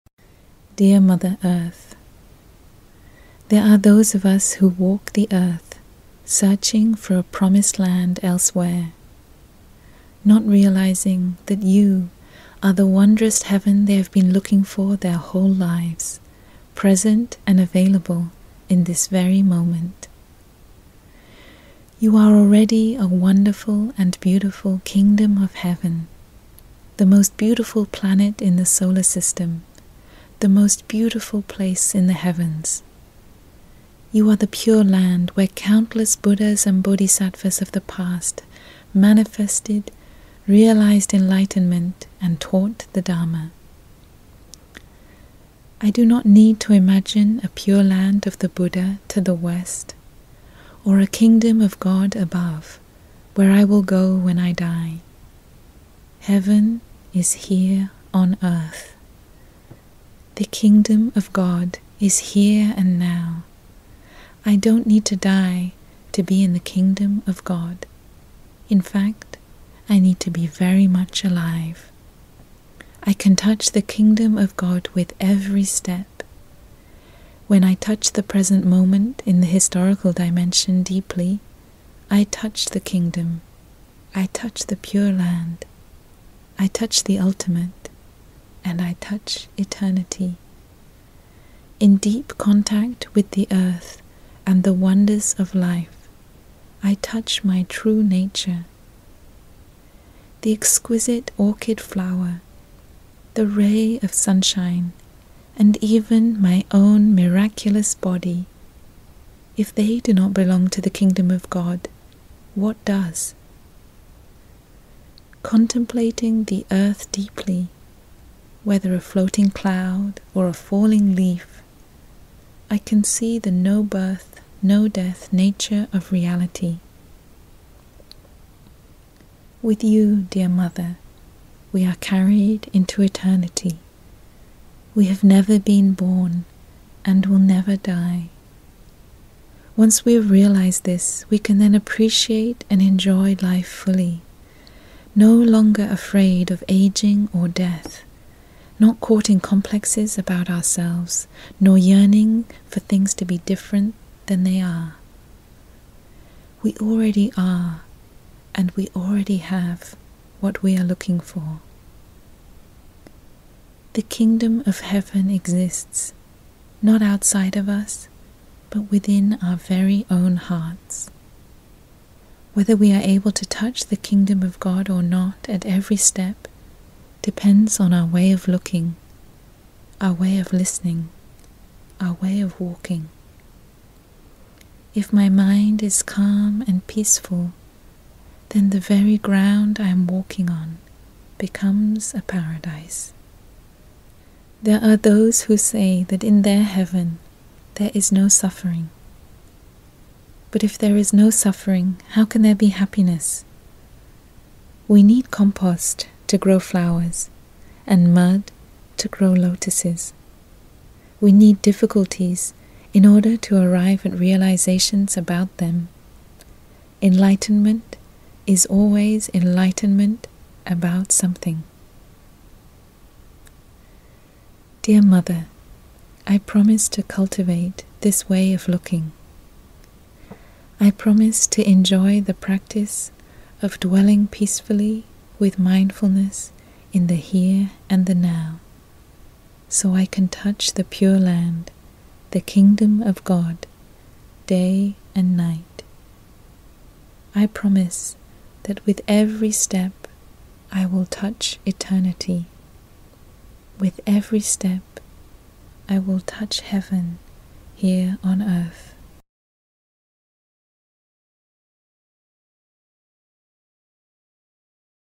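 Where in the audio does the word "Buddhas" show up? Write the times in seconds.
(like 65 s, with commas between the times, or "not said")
36 s, 48 s.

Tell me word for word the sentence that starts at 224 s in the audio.
Dear Mother, I promise to cultivate this way of looking.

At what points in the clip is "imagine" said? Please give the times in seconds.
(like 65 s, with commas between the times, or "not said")
46 s.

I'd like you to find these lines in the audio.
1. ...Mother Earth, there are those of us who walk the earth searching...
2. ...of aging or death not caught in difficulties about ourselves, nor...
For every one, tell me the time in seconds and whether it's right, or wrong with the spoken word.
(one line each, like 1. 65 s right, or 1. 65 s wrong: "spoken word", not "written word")
1. 1 s right
2. 146 s wrong: "complexes", not "difficulties".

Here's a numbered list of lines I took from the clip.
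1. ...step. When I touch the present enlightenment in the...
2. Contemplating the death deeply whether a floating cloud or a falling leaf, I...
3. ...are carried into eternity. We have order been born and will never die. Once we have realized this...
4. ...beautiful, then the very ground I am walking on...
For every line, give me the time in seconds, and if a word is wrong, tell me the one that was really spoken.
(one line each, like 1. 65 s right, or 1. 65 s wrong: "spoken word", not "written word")
1. 75 s wrong: "moment", not "enlightenment"
2. 115 s wrong: "earth", not "death"
3. 131 s wrong: "never", not "order"
4. 186 s wrong: "peaceful", not "beautiful".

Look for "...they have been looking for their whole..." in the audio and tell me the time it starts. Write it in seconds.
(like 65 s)
13 s.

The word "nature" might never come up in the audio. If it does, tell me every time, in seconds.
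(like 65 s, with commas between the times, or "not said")
98 s, 125 s.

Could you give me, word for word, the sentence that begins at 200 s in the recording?
But if there is no suffering, how can there be happiness?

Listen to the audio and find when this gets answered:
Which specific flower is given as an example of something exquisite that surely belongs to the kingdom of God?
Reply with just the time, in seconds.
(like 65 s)
101 s.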